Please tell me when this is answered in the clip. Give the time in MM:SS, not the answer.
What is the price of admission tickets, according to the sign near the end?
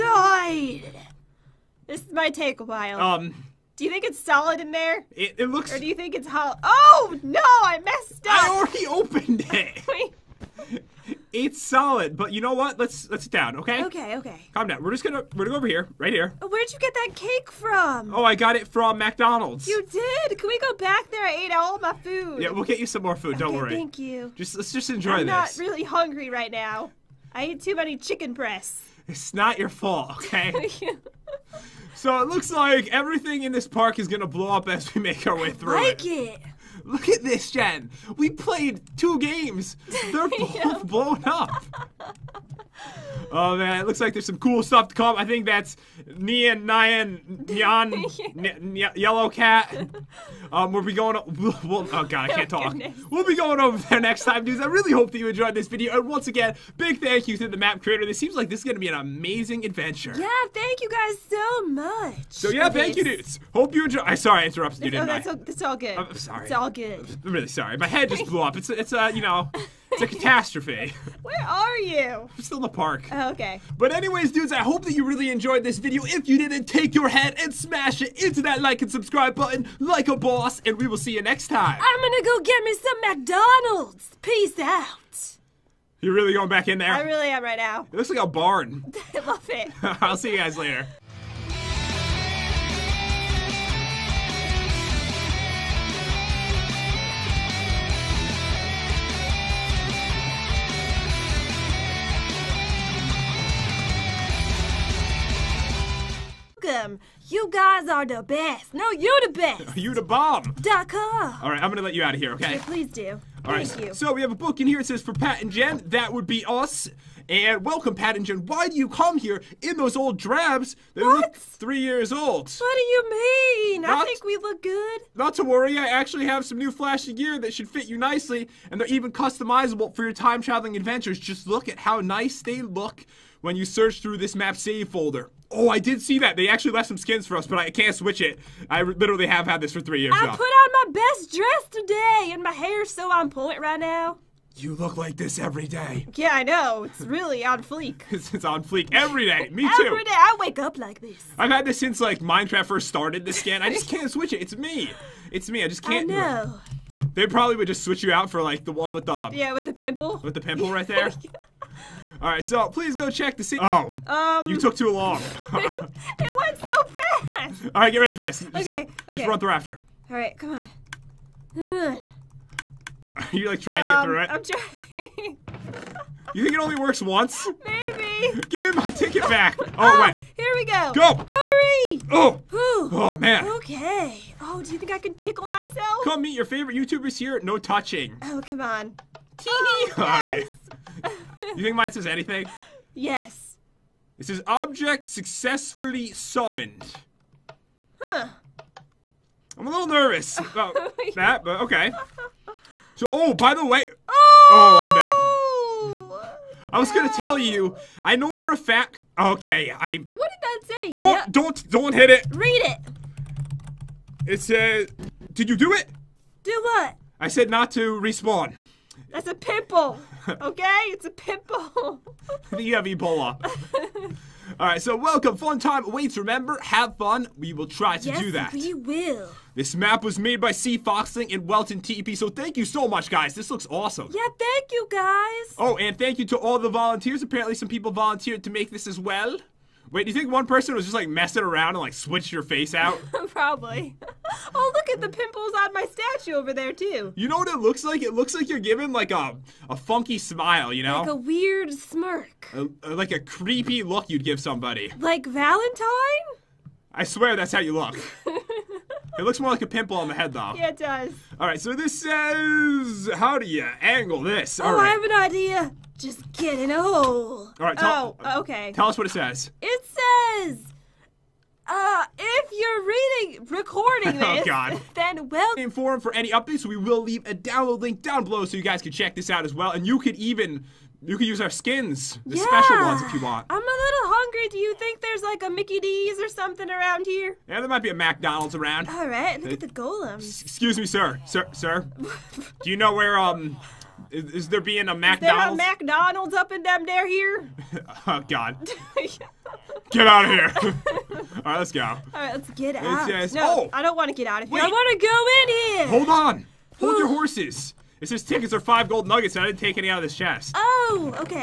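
05:08.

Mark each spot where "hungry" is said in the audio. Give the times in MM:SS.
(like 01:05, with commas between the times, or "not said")
00:25, 04:44.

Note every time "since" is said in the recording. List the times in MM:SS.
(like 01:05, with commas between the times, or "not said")
02:31.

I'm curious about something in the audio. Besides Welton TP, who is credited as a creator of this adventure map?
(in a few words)
C. Foxling.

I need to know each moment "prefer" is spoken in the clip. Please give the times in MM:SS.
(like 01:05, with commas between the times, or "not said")
not said.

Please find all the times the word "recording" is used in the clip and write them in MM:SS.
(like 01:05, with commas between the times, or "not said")
04:33.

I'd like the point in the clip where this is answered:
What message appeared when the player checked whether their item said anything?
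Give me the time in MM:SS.
03:14.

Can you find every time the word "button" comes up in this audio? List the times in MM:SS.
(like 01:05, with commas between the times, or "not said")
01:19.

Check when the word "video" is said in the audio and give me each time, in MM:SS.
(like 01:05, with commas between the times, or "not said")
00:55, 01:15.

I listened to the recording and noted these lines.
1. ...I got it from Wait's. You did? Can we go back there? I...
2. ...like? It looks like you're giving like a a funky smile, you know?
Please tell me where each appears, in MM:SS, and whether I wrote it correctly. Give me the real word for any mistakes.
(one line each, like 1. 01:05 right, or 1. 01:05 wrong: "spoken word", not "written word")
1. 00:18 wrong: "McDonald", not "Wait"
2. 04:07 right.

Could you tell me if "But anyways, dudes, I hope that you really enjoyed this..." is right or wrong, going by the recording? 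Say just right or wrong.
right.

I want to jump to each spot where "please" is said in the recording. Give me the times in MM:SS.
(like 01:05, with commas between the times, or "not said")
01:52, 02:42.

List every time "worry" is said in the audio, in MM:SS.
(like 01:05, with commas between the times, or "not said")
00:23, 02:05.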